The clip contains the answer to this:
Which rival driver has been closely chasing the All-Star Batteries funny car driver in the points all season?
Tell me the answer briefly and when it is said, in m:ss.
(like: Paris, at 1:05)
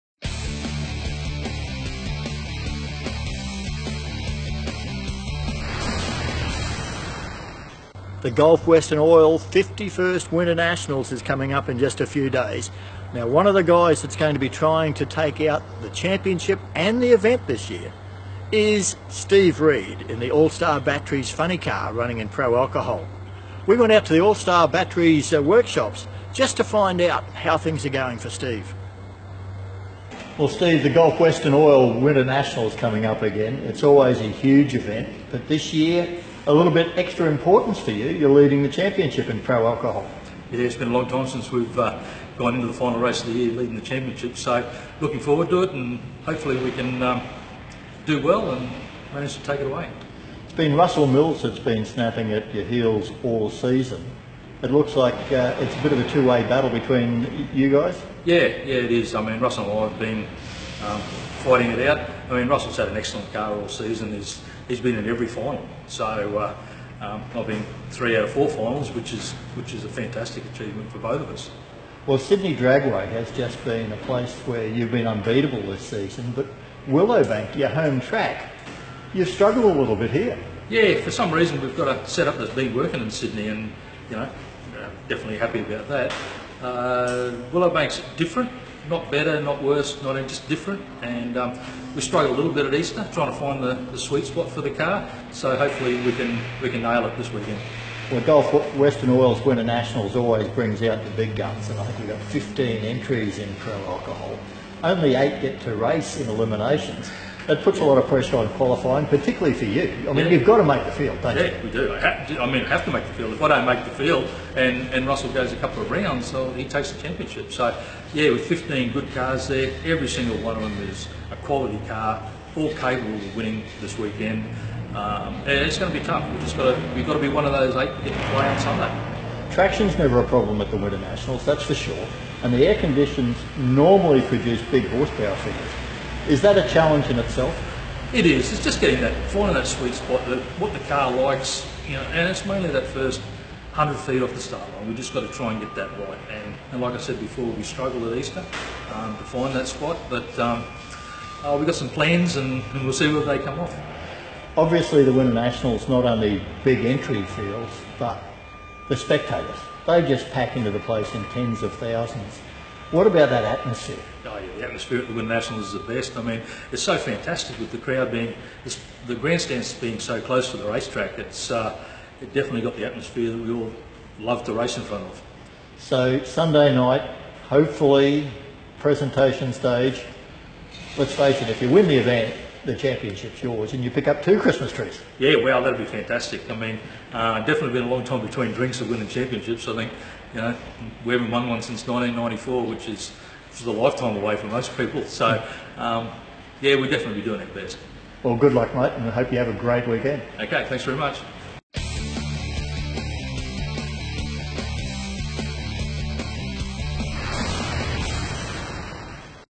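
Russell Mills, at 0:50.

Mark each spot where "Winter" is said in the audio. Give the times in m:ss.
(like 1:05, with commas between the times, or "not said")
0:10, 0:31, 1:39, 2:10, 2:35, 2:45.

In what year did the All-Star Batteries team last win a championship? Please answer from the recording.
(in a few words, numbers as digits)
1994.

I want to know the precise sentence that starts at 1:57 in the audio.
So, yeah, with 15 good cars there, every single one of them is a quality car, all capable of winning this weekend.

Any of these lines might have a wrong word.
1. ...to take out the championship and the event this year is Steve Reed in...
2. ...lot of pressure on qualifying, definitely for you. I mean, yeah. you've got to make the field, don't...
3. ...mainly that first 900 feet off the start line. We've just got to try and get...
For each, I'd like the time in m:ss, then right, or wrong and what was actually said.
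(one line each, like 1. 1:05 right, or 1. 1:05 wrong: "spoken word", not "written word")
1. 0:14 right
2. 1:47 wrong: "particularly", not "definitely"
3. 2:22 wrong: "100", not "900".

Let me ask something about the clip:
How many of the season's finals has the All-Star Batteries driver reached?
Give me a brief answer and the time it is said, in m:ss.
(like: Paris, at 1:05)
3 out of 4, at 1:07.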